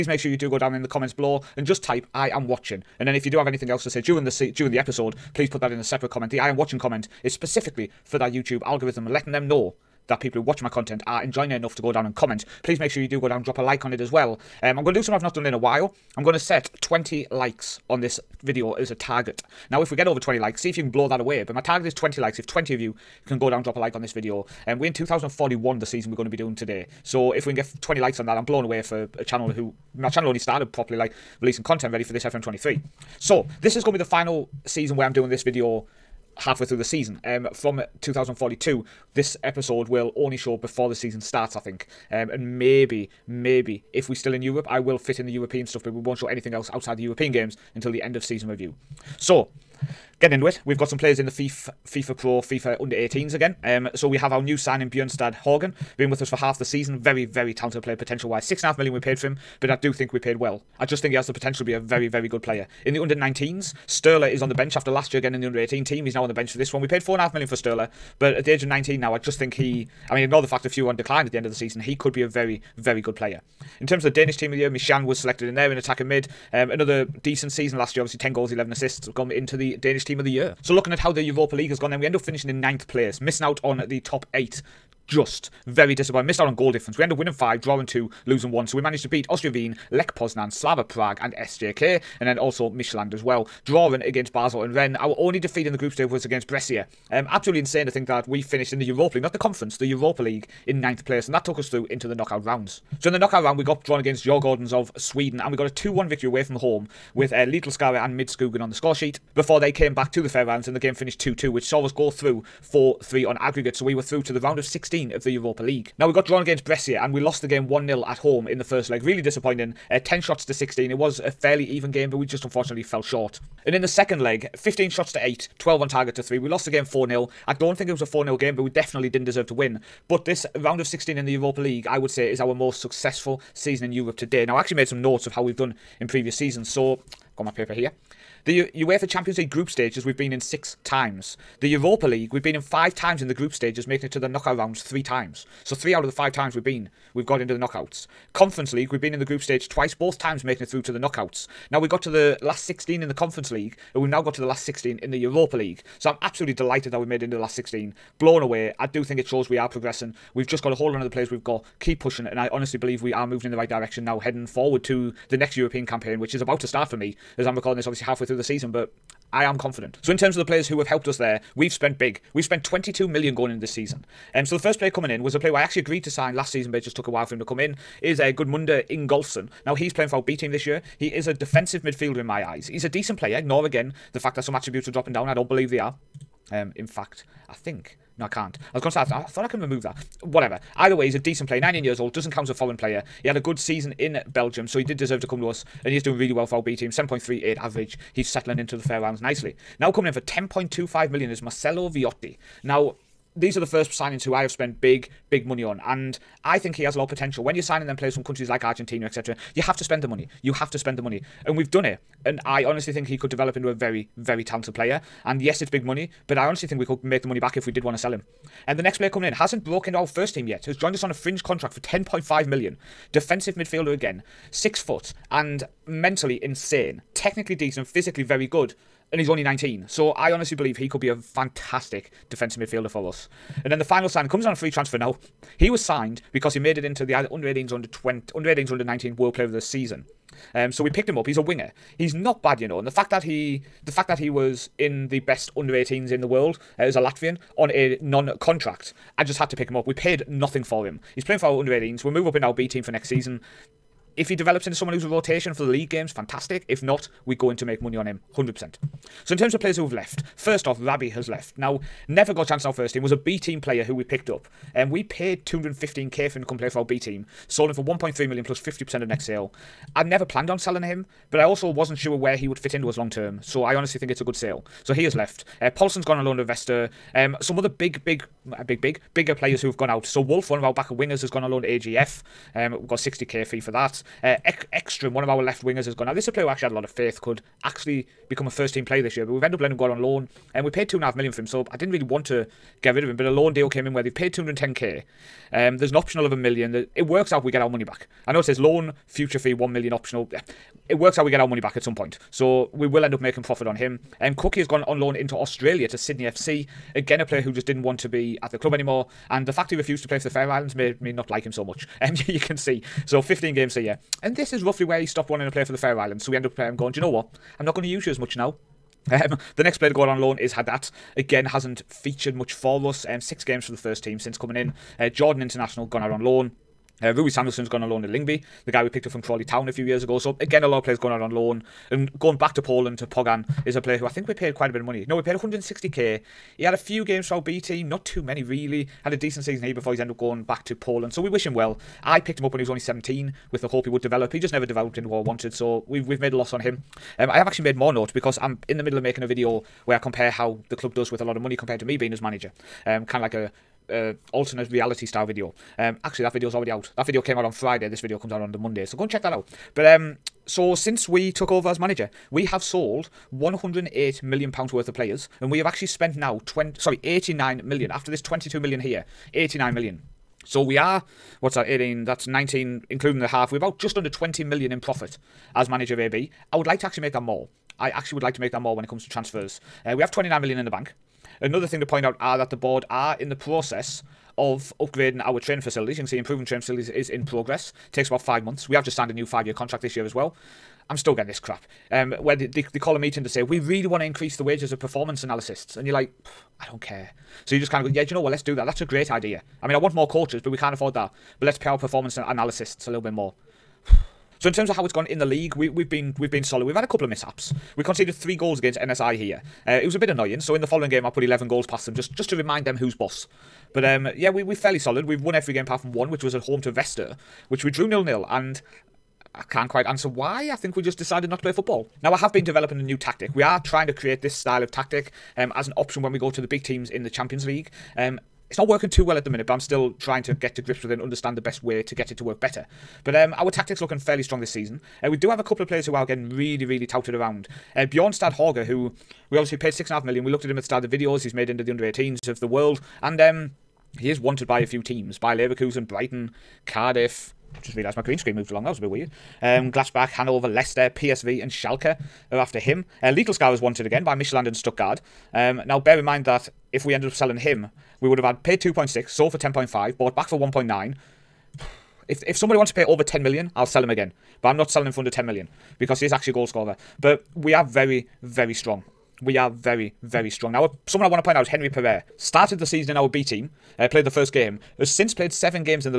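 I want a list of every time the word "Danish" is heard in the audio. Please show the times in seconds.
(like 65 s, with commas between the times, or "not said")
74 s, 79 s.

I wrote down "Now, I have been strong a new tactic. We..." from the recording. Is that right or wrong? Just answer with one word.
wrong.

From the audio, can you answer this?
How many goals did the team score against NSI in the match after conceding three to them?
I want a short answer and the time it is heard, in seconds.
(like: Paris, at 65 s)
11, at 411 s.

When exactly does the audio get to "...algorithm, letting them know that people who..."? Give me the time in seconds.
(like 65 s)
8 s.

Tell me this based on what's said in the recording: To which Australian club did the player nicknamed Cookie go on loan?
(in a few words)
Sydney FC.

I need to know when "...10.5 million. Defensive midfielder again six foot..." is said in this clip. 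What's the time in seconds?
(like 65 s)
221 s.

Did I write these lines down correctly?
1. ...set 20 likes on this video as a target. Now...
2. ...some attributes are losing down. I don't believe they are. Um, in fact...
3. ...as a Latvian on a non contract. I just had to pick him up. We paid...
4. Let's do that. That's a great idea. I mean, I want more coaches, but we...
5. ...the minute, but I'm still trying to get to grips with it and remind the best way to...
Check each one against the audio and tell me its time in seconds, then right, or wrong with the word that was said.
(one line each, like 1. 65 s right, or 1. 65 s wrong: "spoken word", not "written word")
1. 16 s right
2. 184 s wrong: "dropping", not "losing"
3. 246 s right
4. 398 s right
5. 429 s wrong: "understand", not "remind".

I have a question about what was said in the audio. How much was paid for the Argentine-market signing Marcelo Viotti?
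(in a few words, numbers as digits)
10.25 million.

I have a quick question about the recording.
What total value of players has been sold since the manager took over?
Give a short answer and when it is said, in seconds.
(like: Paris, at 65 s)
108 million pounds, at 363 s.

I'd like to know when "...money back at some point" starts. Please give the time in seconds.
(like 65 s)
301 s.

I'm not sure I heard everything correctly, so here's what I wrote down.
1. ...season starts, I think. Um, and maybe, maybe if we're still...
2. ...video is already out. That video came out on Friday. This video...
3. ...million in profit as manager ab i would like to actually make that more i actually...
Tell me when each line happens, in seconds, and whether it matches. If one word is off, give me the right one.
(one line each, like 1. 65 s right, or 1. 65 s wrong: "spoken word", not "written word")
1. 40 s right
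2. 356 s right
3. 374 s right.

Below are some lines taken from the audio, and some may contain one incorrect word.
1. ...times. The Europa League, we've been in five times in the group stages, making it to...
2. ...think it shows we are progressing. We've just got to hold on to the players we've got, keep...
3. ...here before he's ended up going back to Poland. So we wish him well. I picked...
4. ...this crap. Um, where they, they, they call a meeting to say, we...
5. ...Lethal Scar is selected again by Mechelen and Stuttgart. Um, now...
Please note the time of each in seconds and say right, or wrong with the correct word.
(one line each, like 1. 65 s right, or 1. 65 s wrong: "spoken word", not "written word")
1. 140 s right
2. 159 s right
3. 339 s right
4. 391 s right
5. 453 s wrong: "wanted", not "selected".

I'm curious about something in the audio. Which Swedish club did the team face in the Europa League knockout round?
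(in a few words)
Djurgårdens.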